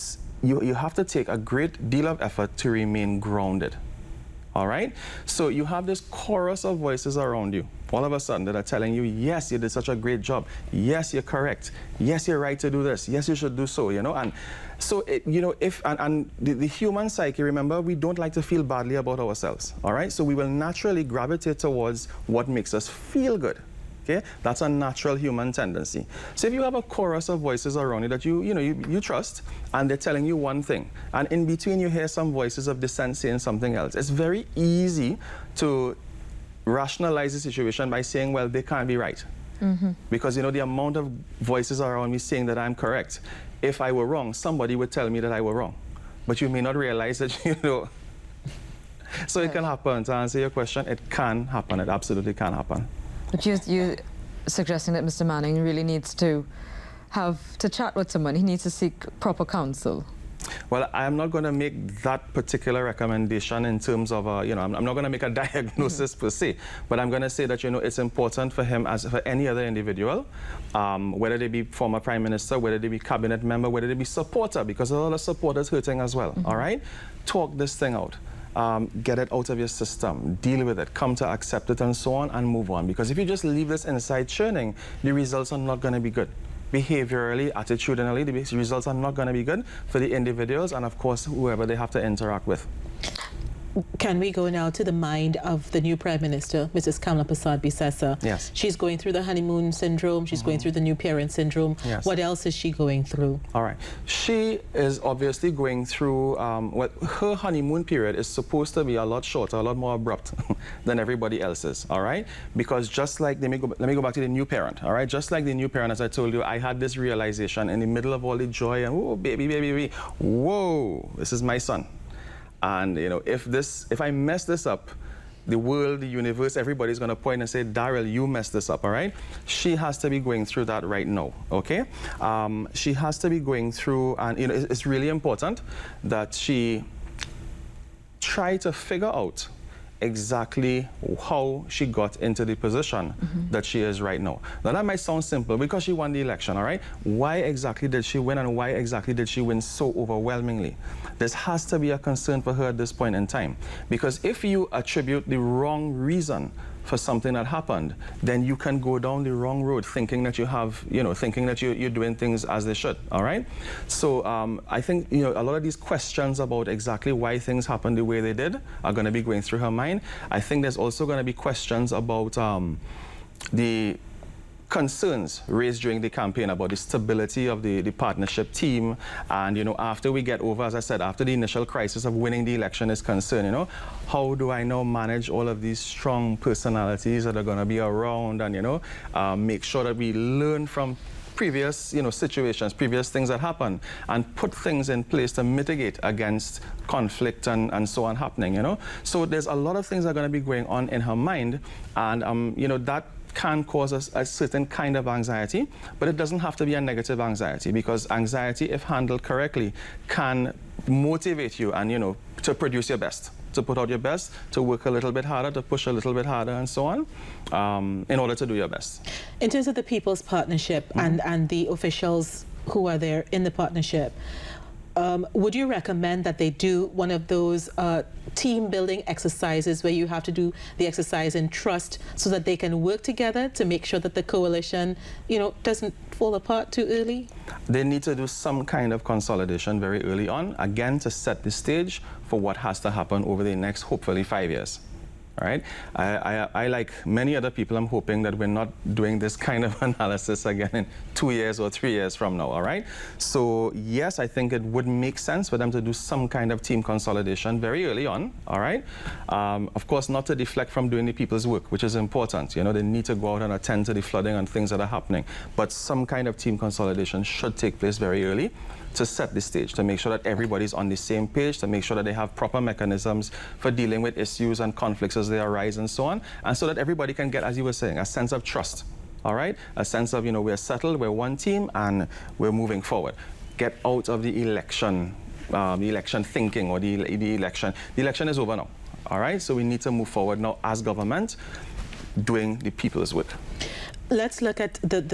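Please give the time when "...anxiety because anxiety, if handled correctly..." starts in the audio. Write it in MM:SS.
03:27.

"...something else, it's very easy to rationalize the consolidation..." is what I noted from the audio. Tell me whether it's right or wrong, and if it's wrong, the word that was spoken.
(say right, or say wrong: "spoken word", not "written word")
wrong: "situation", not "consolidation".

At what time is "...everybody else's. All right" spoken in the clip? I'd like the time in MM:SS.
01:50.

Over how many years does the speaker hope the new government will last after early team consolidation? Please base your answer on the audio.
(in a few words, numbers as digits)
5 years.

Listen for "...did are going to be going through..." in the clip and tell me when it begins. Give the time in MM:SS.
02:48.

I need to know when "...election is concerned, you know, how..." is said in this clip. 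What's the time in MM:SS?
03:02.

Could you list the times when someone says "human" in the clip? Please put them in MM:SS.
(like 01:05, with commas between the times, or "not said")
00:16, 00:25.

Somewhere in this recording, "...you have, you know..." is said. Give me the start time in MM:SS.
02:40.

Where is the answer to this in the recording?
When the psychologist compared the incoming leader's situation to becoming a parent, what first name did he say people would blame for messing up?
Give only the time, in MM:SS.
02:07.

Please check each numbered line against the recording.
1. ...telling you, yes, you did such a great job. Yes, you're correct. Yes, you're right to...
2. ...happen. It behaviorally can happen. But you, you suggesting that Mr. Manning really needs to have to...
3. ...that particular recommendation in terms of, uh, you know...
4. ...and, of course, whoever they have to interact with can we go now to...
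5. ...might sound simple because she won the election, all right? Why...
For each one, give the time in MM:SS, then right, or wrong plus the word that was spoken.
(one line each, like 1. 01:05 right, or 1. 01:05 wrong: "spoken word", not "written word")
1. 00:08 right
2. 00:51 wrong: "absolutely", not "behaviorally"
3. 01:02 right
4. 01:30 right
5. 02:24 right.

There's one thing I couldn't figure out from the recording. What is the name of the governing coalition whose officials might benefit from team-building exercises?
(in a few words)
People's Partnership.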